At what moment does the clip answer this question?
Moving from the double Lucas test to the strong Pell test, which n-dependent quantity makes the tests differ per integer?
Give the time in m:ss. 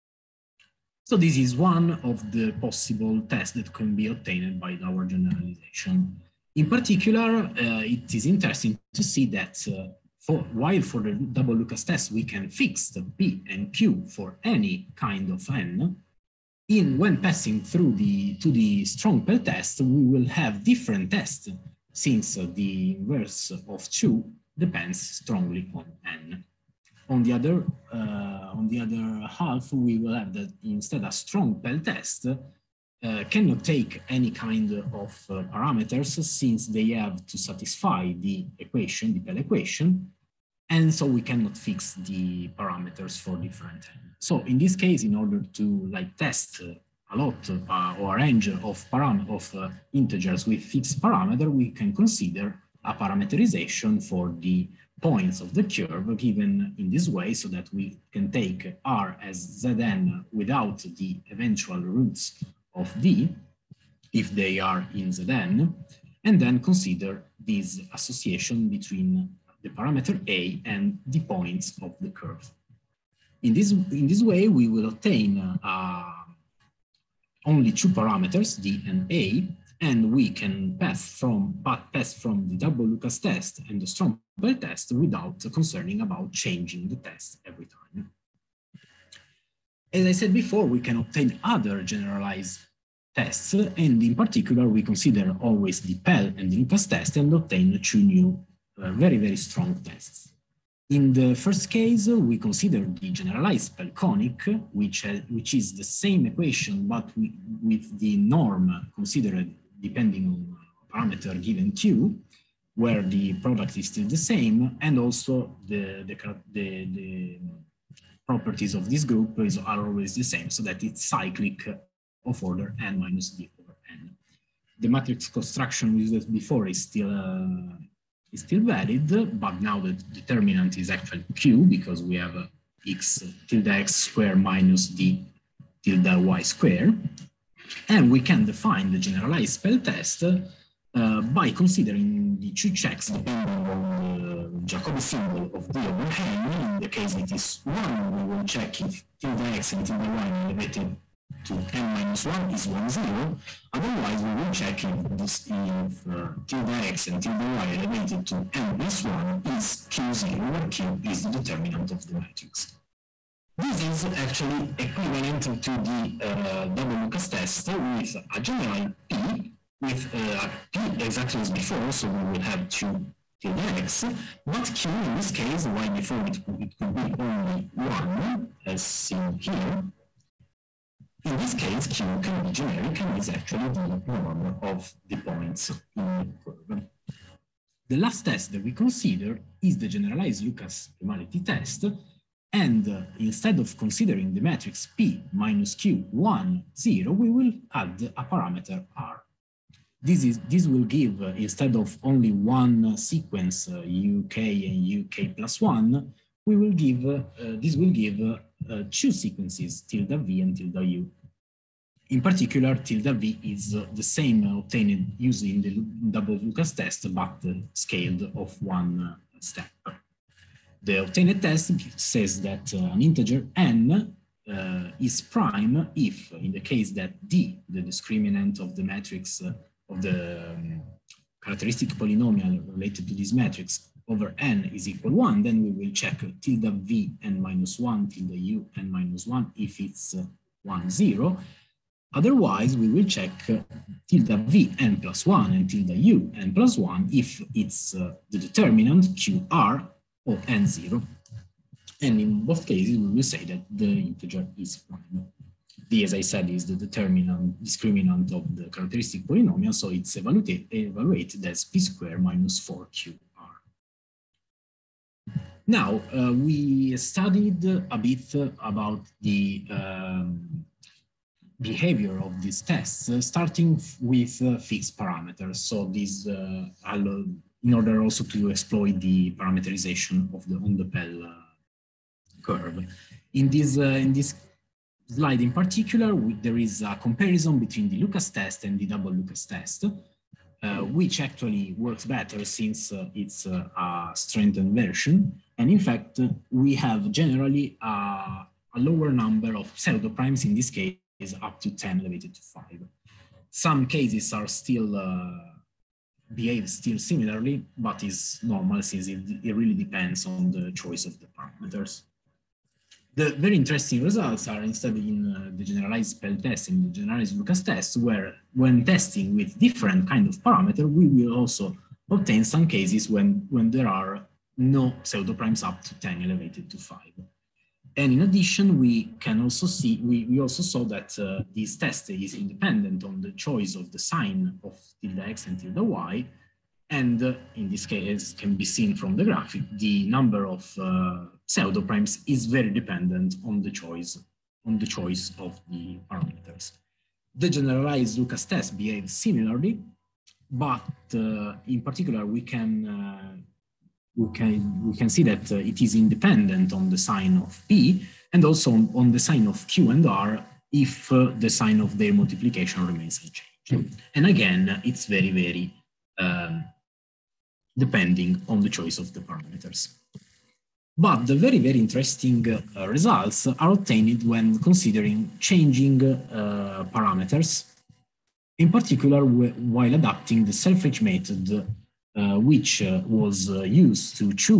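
0:22.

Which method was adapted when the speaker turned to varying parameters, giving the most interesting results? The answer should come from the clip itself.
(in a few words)
the Selfridge method.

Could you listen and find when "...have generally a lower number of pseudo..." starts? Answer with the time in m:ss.
4:56.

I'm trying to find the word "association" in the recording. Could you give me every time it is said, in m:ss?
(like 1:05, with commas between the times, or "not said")
1:07.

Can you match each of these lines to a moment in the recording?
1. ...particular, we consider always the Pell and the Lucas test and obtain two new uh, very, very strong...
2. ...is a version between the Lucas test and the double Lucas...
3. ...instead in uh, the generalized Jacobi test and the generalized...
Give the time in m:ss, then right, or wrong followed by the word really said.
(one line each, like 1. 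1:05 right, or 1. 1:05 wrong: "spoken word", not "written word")
1. 1:34 right
2. 4:46 wrong: "comparison", not "version"
3. 5:14 wrong: "Pell", not "Jacobi".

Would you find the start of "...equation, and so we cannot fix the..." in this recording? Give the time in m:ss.
0:39.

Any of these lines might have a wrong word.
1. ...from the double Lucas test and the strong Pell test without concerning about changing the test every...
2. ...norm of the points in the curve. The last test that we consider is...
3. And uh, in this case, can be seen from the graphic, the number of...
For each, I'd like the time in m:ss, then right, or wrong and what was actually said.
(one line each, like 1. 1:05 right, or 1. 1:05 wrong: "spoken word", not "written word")
1. 1:22 right
2. 3:04 right
3. 5:36 right.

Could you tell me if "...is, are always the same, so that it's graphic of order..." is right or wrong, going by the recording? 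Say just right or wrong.
wrong.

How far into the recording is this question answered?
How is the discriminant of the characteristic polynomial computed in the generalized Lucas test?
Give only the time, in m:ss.
4:21.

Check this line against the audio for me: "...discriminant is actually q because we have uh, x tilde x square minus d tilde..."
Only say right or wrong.
wrong.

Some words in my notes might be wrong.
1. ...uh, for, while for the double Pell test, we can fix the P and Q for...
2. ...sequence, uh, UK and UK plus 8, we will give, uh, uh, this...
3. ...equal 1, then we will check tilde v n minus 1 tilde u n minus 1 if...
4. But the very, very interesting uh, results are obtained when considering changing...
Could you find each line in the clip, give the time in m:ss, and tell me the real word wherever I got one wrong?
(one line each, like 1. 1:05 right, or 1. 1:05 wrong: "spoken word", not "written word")
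1. 0:09 wrong: "Lucas", not "Pell"
2. 3:22 wrong: "1", not "8"
3. 3:54 right
4. 6:10 right.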